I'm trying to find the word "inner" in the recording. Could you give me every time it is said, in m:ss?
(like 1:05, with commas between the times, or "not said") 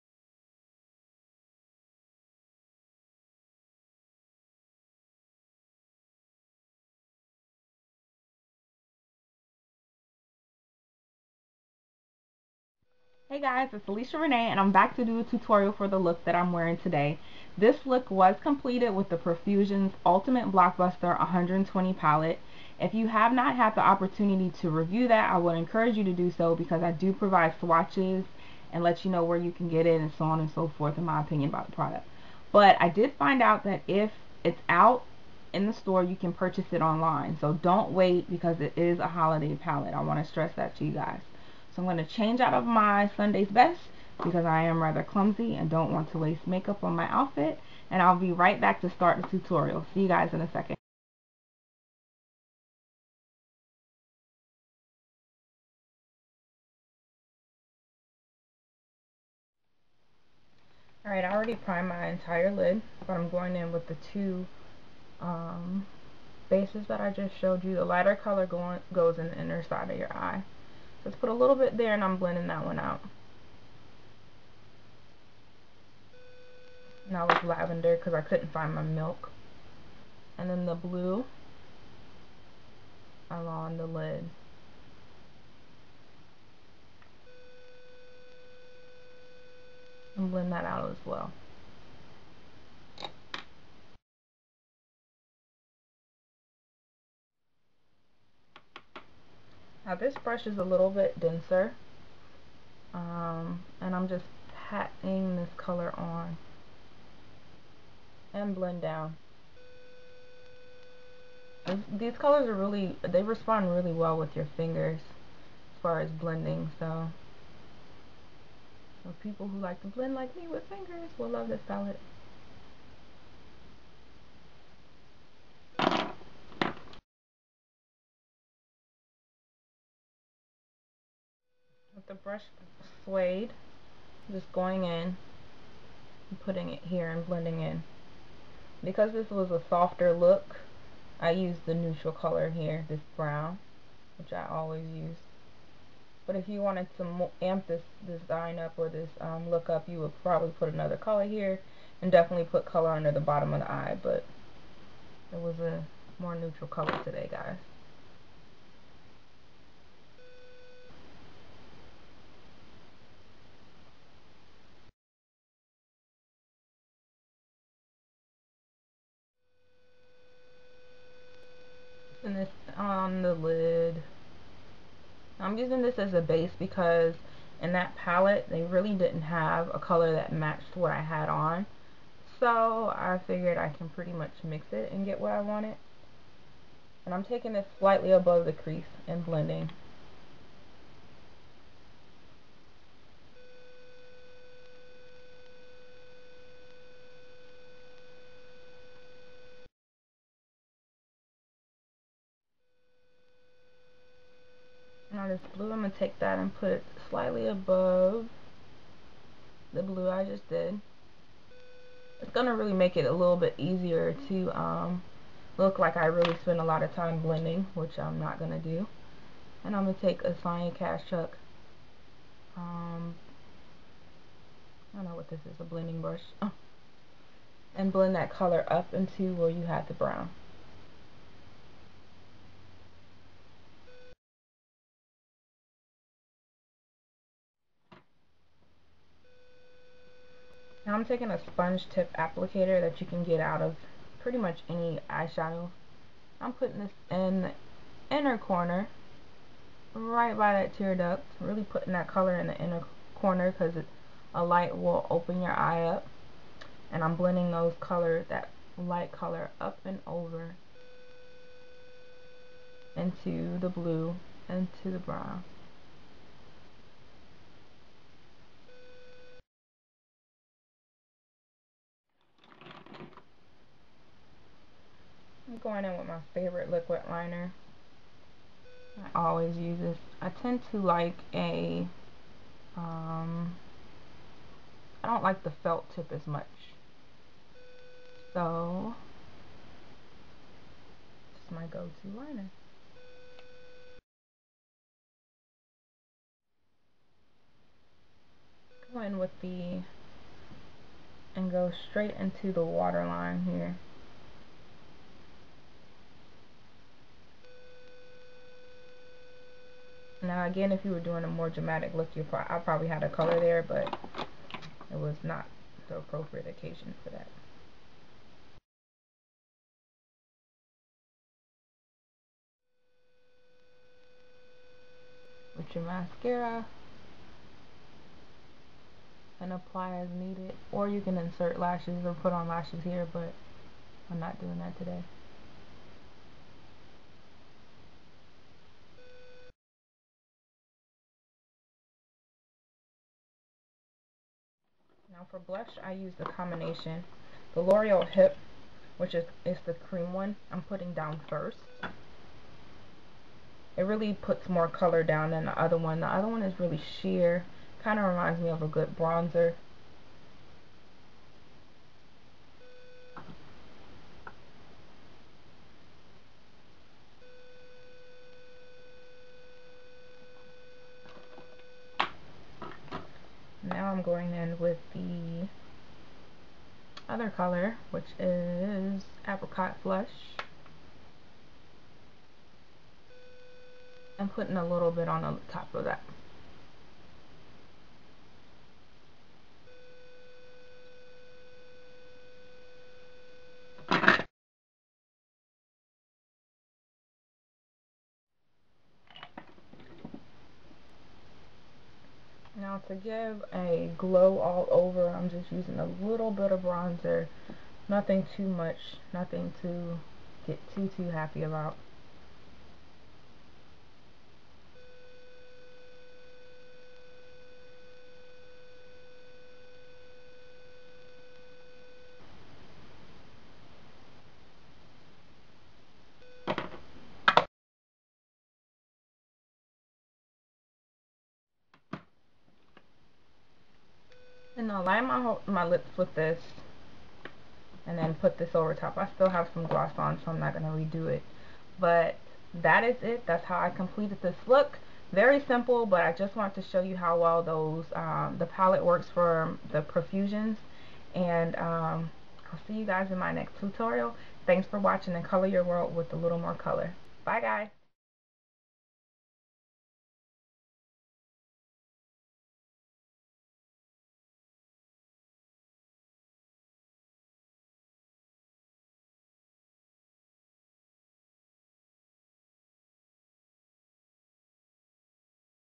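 1:09, 4:08, 4:12.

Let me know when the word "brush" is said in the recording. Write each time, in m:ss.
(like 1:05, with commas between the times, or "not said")
1:40, 2:12, 3:46.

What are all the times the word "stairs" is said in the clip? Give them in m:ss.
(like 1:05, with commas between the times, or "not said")
not said.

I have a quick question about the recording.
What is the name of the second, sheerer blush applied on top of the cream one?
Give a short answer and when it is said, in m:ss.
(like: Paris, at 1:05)
Apricot Flush, at 6:19.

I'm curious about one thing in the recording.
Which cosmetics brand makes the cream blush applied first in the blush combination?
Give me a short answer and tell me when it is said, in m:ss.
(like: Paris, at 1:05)
L'Oreal, at 5:47.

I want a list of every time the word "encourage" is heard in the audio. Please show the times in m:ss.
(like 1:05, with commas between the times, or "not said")
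0:25.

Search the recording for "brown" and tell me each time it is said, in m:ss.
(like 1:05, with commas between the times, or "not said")
2:23, 3:49, 4:24.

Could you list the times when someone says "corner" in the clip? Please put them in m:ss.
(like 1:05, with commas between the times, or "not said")
4:08, 4:13.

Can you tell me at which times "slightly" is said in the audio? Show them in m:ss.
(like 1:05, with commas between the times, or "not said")
3:07, 3:27.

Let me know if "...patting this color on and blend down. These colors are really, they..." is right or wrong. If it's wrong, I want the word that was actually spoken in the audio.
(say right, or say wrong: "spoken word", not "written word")
right.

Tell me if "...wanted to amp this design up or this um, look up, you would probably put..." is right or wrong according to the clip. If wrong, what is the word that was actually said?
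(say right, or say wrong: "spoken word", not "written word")
right.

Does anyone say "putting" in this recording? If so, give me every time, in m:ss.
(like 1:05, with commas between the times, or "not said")
2:16, 4:06, 4:11, 5:50, 6:24.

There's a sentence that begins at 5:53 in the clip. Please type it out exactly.
It really puts more color down than the other one.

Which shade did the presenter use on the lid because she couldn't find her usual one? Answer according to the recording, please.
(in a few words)
lavender.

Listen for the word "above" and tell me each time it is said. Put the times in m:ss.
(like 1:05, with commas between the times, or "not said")
3:08, 3:27.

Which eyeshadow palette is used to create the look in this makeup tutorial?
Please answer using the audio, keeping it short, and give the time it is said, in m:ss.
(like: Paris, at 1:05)
Profusions Ultimate Blockbuster 120, at 0:19.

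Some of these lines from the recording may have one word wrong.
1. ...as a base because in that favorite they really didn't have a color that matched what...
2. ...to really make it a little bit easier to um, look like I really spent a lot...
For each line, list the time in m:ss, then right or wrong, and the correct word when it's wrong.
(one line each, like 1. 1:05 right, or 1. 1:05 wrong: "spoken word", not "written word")
1. 2:55 wrong: "palette", not "favorite"
2. 3:32 right.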